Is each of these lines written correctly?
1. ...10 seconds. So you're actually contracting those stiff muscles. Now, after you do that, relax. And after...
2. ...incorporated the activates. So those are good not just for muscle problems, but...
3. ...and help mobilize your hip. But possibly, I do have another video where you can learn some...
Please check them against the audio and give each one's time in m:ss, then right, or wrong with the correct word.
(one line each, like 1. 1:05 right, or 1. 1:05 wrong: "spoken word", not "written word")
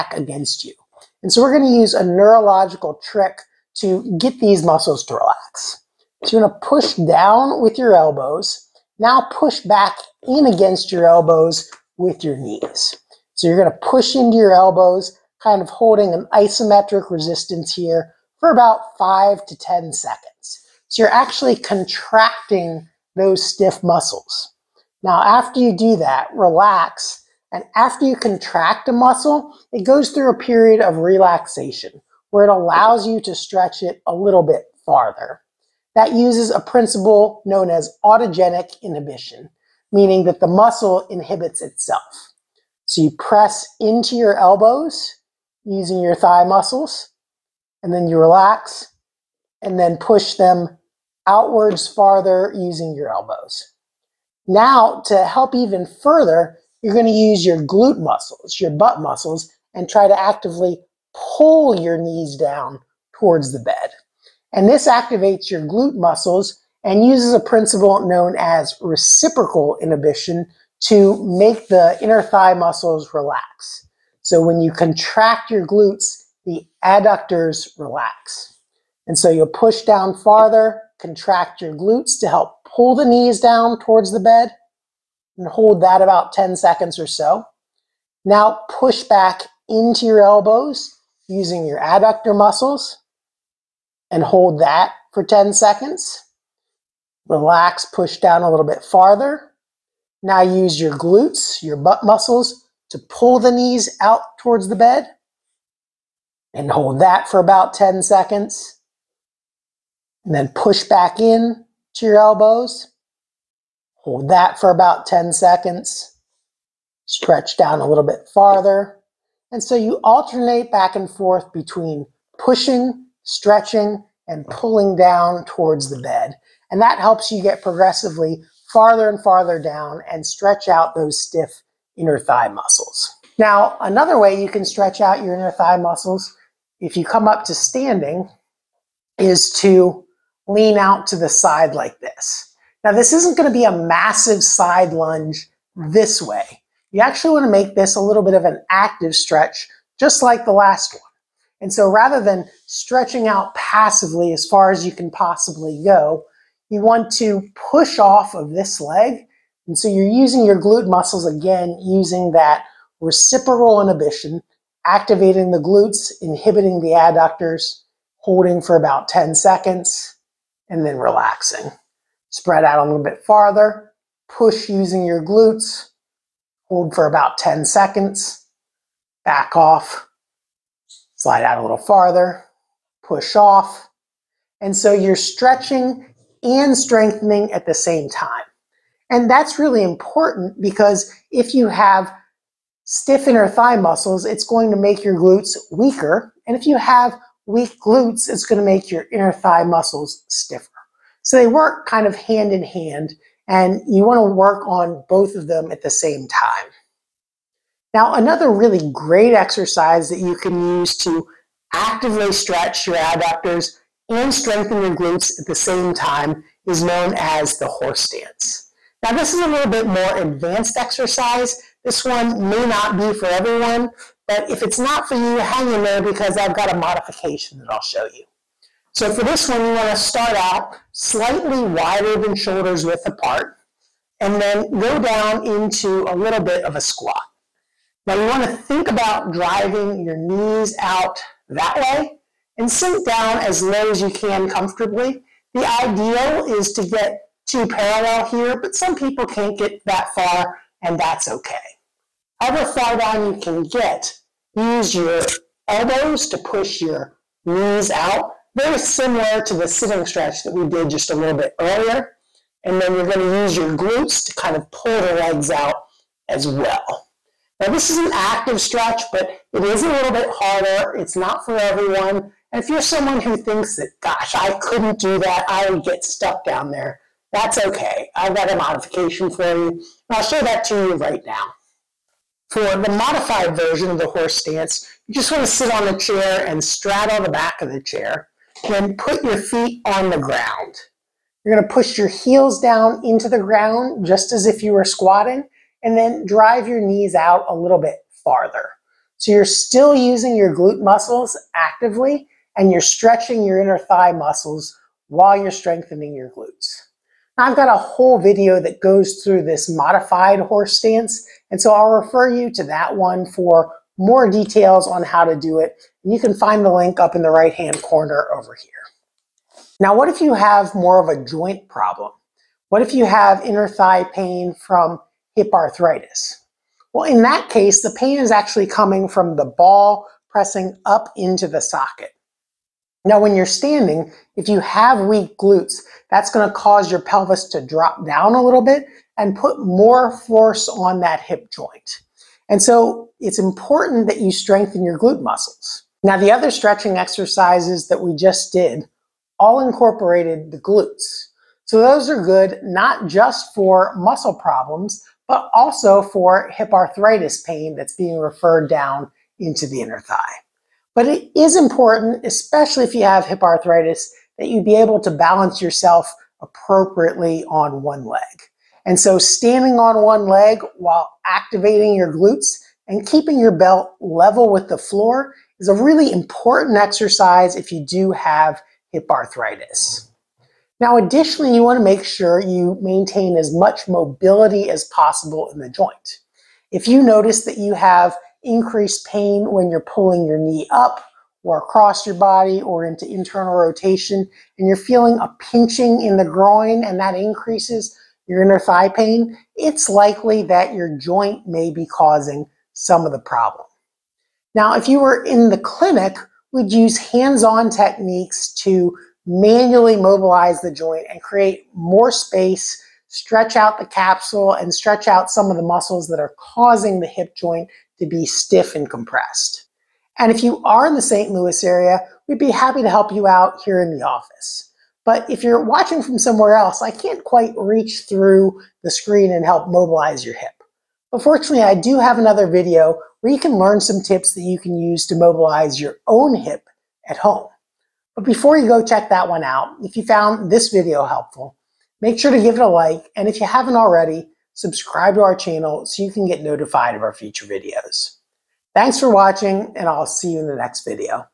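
1. 0:19 right
2. 5:49 wrong: "glutes", not "activates"
3. 7:09 wrong: "fortunately", not "possibly".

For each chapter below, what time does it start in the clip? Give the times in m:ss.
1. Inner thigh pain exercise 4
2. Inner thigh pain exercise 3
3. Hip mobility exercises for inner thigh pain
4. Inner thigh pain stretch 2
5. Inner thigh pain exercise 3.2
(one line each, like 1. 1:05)
1. 6:20
2. 3:46
3. 6:40
4. 2:29
5. 5:00.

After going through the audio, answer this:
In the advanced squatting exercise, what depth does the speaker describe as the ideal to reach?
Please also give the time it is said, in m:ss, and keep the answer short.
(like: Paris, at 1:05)
parallel, at 4:07.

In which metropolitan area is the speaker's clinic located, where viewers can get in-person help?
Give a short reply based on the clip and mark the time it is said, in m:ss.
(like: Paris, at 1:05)
St. Louis, at 7:01.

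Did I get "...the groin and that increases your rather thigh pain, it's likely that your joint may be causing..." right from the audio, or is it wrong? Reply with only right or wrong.
wrong.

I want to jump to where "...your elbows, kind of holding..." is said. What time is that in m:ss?
0:14.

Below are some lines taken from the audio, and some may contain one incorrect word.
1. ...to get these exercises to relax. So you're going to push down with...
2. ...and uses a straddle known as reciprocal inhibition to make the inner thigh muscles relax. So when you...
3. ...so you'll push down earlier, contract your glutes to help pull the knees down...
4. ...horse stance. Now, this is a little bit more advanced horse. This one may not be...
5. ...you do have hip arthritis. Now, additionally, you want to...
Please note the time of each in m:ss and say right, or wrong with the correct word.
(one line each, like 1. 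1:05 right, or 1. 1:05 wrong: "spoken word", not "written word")
1. 0:03 wrong: "muscles", not "exercises"
2. 1:06 wrong: "principle", not "straddle"
3. 1:19 wrong: "farther", not "earlier"
4. 3:37 wrong: "exercise", not "horse"
5. 6:17 right.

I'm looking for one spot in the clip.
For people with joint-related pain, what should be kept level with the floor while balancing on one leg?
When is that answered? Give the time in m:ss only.
6:13.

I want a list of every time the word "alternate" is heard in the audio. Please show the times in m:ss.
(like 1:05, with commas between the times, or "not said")
2:00.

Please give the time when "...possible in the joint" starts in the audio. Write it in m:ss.
6:24.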